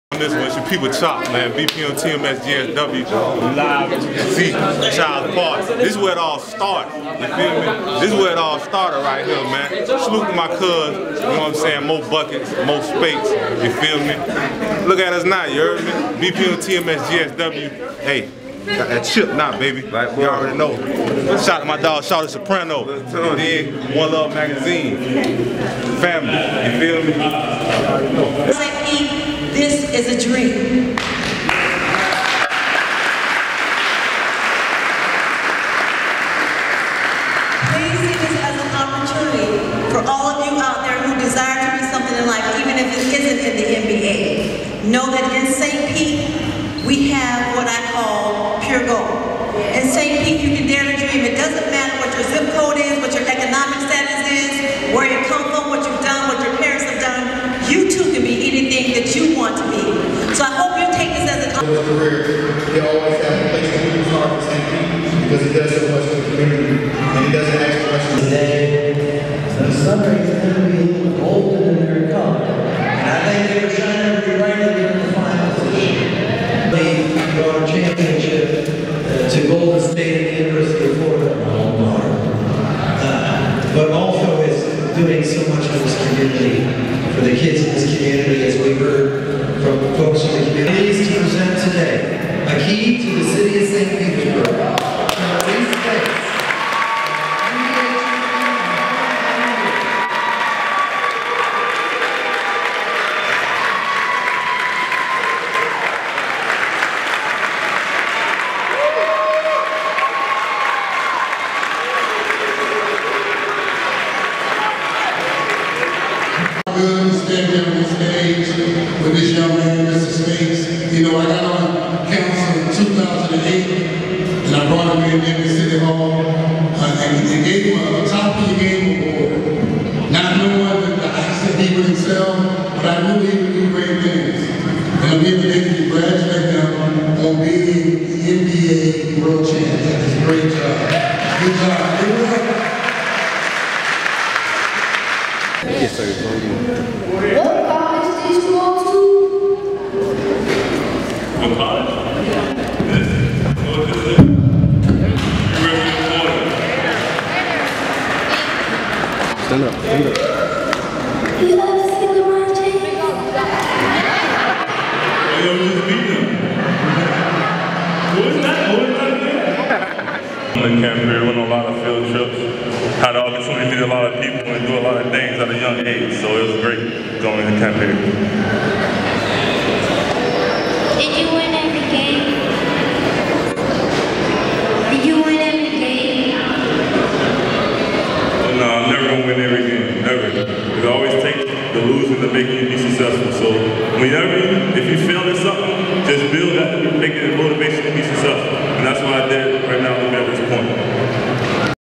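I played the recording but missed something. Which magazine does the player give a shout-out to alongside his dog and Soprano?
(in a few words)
One Love Magazine.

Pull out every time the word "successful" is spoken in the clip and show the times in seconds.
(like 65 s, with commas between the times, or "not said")
192 s, 198 s.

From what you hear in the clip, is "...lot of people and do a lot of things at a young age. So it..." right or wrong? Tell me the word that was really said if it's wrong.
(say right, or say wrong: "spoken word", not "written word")
right.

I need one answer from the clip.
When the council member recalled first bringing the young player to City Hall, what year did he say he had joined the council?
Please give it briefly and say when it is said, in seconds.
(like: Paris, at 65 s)
2008, at 122 s.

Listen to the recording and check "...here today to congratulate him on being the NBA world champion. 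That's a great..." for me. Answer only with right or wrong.
right.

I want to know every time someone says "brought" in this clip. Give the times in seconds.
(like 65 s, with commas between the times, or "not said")
77 s, 124 s.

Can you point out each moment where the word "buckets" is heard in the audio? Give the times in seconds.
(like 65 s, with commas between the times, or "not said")
12 s.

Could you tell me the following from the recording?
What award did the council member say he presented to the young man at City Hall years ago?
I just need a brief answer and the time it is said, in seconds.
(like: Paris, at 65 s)
Top of the game award, at 128 s.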